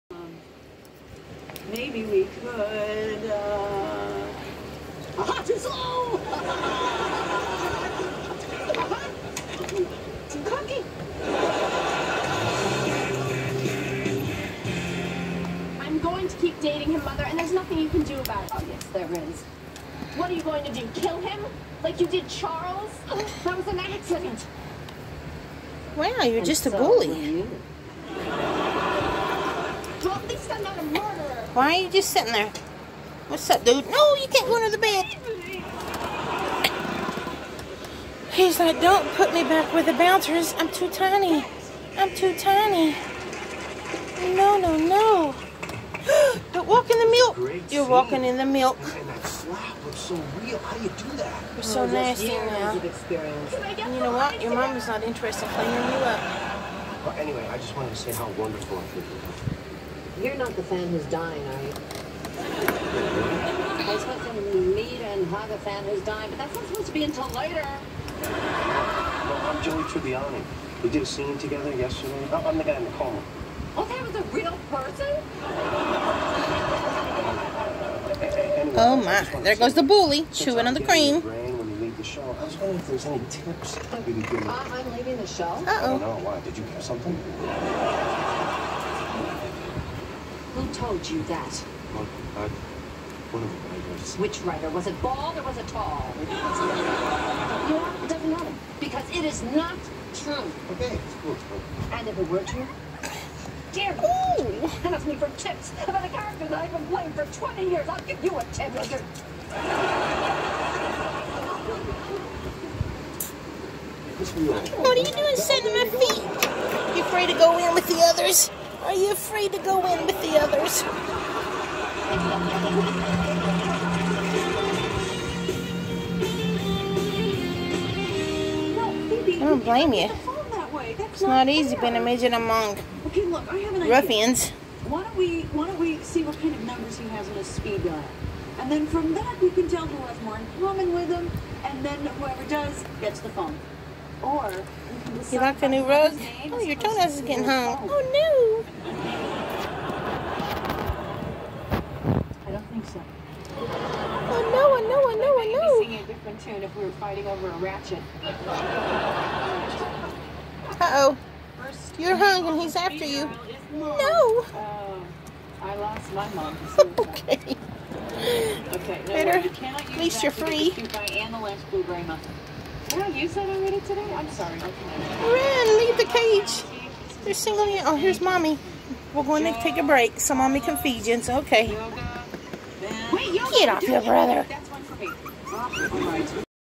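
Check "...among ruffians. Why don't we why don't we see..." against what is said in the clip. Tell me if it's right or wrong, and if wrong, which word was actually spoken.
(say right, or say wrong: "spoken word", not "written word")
right.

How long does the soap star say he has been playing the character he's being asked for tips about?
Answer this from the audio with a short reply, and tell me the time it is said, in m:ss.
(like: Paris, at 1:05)
20 years, at 1:47.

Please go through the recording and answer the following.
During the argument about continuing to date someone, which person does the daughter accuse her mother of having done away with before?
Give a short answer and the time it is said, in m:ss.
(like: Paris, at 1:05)
Charles, at 0:22.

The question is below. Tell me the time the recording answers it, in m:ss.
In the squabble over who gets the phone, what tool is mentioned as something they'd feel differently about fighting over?
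2:37.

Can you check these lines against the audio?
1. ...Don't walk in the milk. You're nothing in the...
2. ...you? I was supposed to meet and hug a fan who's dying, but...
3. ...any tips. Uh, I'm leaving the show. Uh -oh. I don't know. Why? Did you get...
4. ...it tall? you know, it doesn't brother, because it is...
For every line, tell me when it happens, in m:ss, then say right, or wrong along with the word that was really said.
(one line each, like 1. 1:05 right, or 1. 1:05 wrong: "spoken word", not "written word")
1. 0:46 wrong: "walking", not "nothing"
2. 1:01 right
3. 1:23 right
4. 1:35 wrong: "matter", not "brother".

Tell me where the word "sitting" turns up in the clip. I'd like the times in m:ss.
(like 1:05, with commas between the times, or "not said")
0:32.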